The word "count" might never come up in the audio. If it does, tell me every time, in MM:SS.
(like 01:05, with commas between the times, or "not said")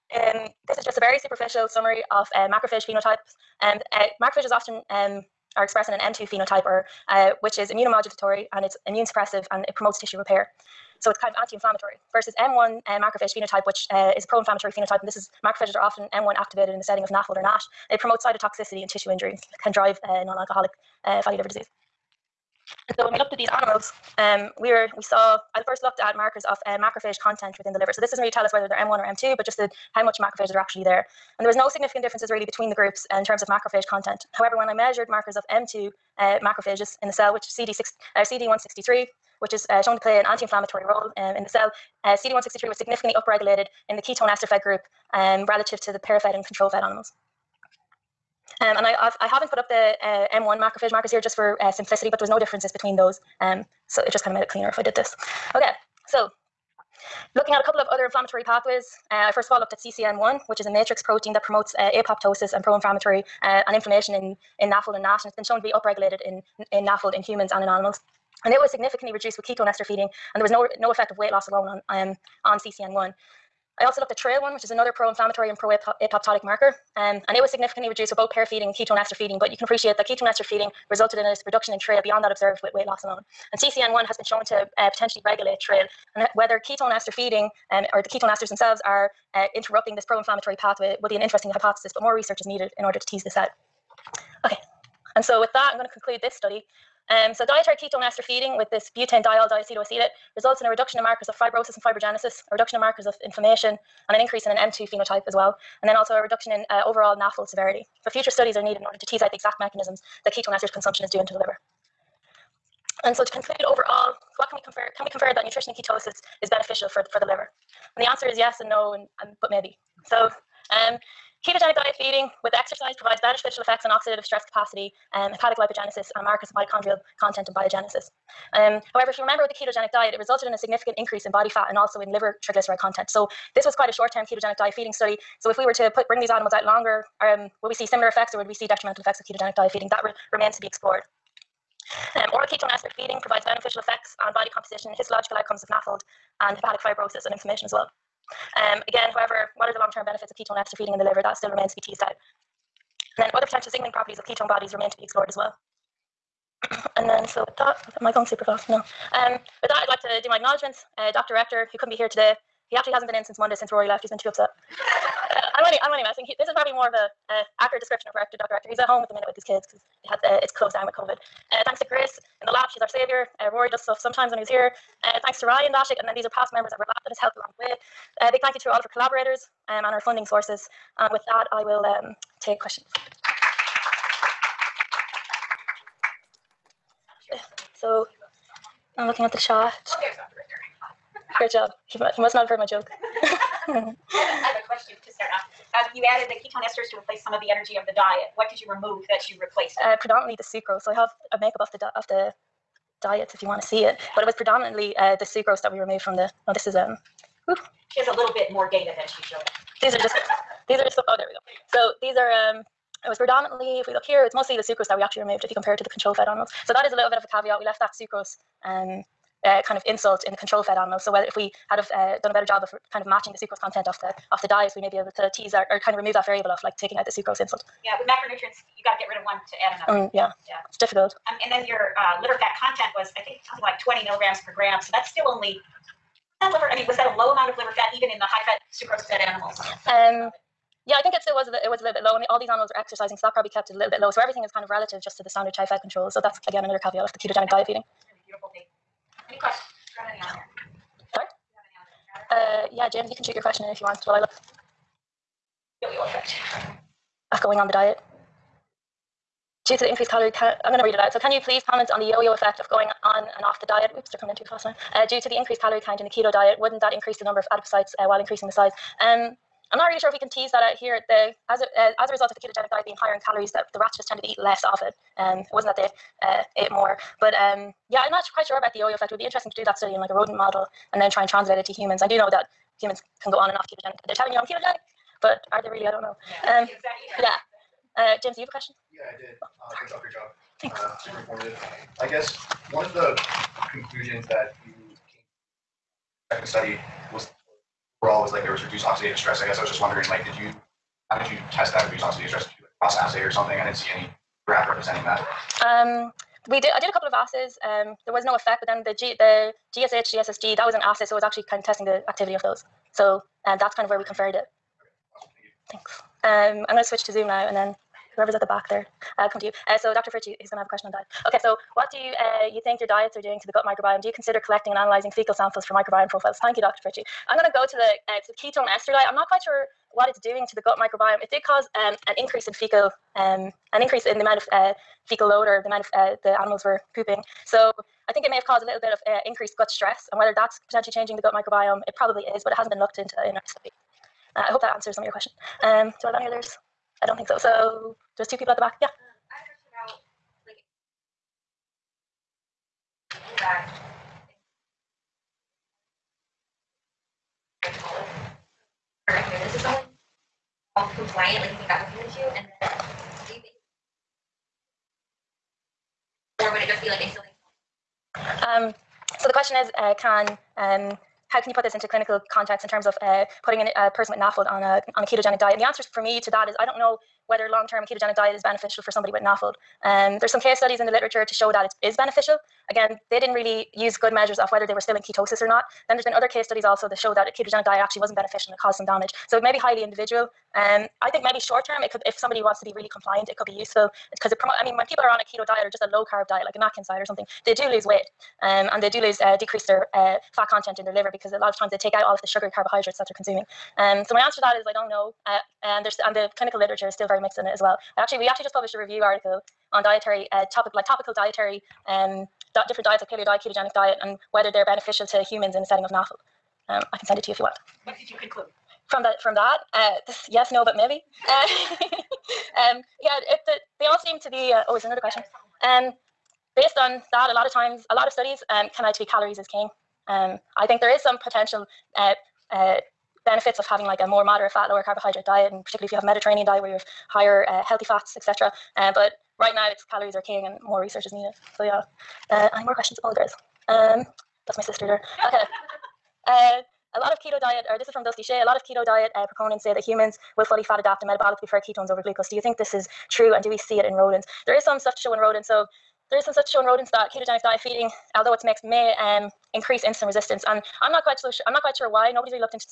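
04:25.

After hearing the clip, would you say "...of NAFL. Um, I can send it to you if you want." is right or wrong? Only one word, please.
right.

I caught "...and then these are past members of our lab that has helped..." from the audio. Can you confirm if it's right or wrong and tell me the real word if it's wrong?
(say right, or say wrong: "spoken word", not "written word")
right.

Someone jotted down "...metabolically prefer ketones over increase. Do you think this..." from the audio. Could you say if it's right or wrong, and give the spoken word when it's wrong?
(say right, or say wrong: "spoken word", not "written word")
wrong: "glucose", not "increase".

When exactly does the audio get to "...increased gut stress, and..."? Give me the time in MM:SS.
05:39.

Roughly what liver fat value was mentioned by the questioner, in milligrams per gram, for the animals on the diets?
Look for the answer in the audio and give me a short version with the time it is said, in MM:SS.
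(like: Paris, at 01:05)
20, at 03:53.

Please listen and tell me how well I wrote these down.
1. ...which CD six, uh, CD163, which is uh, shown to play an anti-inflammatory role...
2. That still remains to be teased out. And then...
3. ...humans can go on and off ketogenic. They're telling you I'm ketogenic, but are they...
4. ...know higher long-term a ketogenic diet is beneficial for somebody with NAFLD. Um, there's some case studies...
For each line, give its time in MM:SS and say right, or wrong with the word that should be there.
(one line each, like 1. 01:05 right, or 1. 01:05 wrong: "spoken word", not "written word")
1. 00:37 right
2. 02:31 right
3. 04:42 right
4. 06:16 wrong: "whether", not "higher".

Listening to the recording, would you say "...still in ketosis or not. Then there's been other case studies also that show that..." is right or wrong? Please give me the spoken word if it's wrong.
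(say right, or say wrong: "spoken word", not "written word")
right.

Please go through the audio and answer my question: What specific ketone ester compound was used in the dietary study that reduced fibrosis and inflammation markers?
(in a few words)
butanediol diacetoacetate.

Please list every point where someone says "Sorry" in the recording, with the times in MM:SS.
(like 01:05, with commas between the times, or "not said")
04:11.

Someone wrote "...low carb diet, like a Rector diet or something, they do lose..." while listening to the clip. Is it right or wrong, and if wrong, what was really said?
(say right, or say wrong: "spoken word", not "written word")
wrong: "Atkins", not "Rector".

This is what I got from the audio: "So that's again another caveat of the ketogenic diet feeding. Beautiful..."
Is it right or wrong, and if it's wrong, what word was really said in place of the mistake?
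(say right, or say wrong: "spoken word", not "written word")
right.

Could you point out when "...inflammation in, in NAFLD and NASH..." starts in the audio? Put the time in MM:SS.
01:03.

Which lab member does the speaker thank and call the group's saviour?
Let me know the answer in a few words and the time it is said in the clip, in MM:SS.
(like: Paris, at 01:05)
Grace, at 02:51.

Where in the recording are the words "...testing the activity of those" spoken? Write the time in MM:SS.
05:11.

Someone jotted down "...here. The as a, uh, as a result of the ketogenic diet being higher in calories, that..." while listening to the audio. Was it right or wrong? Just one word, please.
right.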